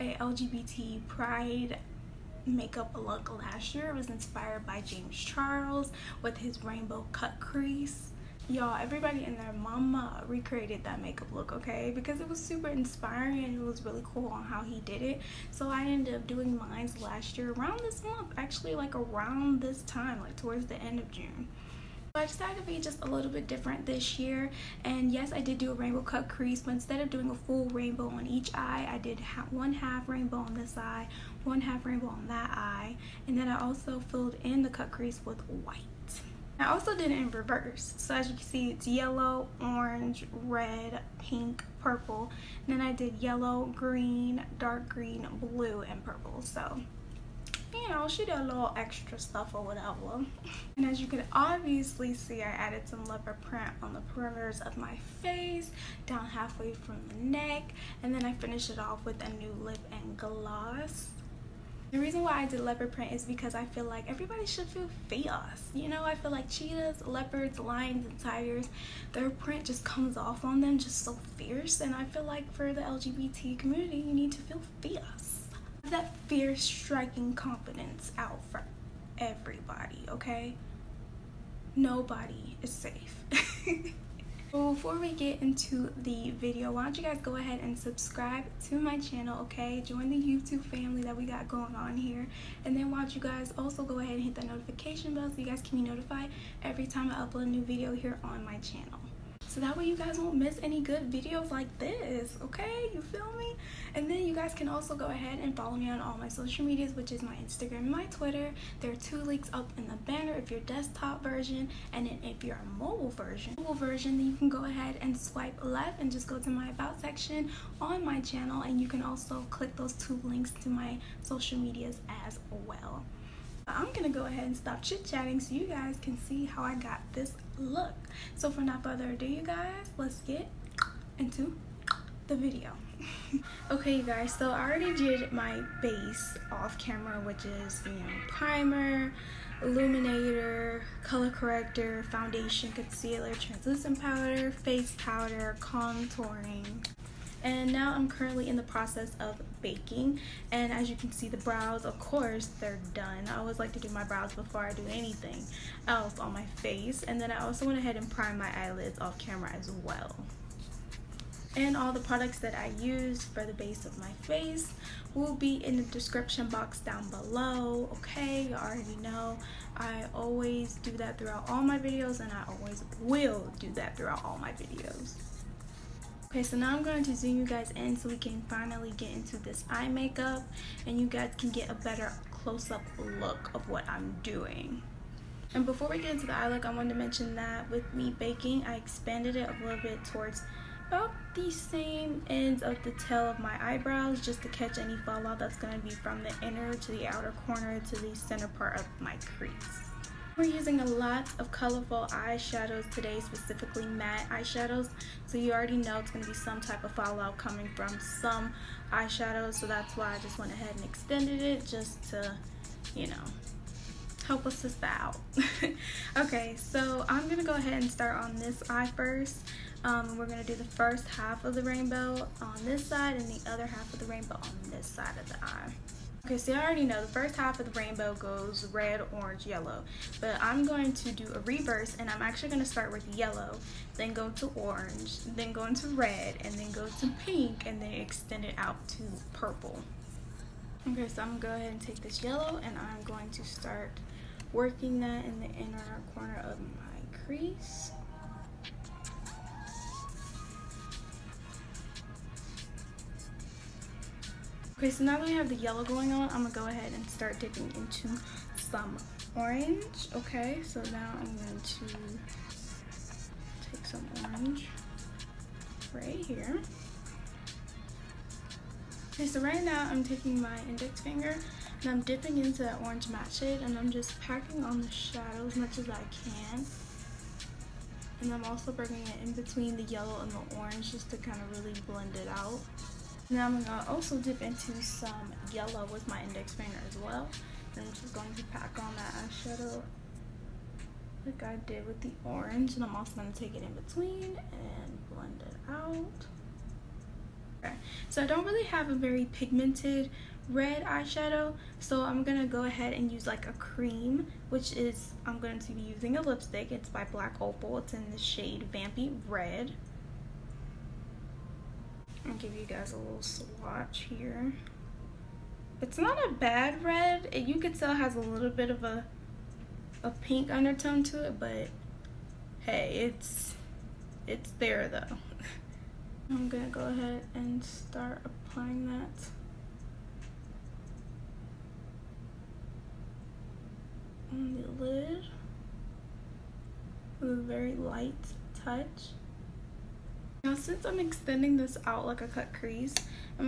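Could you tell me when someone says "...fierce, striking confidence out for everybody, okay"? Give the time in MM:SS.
01:16.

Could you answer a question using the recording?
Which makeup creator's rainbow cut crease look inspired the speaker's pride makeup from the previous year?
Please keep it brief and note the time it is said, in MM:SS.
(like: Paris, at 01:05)
James Charles, at 00:04.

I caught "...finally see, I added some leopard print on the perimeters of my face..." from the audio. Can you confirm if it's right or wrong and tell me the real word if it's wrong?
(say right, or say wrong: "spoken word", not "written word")
wrong: "obviously", not "finally".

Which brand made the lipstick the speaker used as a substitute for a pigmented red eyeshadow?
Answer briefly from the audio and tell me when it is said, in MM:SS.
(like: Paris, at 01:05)
Black Opal, at 05:07.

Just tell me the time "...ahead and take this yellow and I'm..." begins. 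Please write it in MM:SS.
04:01.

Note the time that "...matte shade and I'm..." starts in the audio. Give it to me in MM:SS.
04:33.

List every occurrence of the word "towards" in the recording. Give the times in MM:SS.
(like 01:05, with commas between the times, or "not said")
00:20, 03:10.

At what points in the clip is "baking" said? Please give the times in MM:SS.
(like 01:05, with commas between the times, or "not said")
02:29, 03:08.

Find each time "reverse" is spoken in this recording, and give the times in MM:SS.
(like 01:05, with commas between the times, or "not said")
00:37, 03:51.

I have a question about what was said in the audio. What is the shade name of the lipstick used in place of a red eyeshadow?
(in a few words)
Vampy Red.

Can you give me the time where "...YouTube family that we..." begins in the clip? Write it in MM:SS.
01:30.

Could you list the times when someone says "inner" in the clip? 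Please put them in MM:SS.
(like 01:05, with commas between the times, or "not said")
03:16, 04:05.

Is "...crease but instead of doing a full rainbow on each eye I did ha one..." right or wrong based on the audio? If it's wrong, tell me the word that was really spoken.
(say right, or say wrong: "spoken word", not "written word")
right.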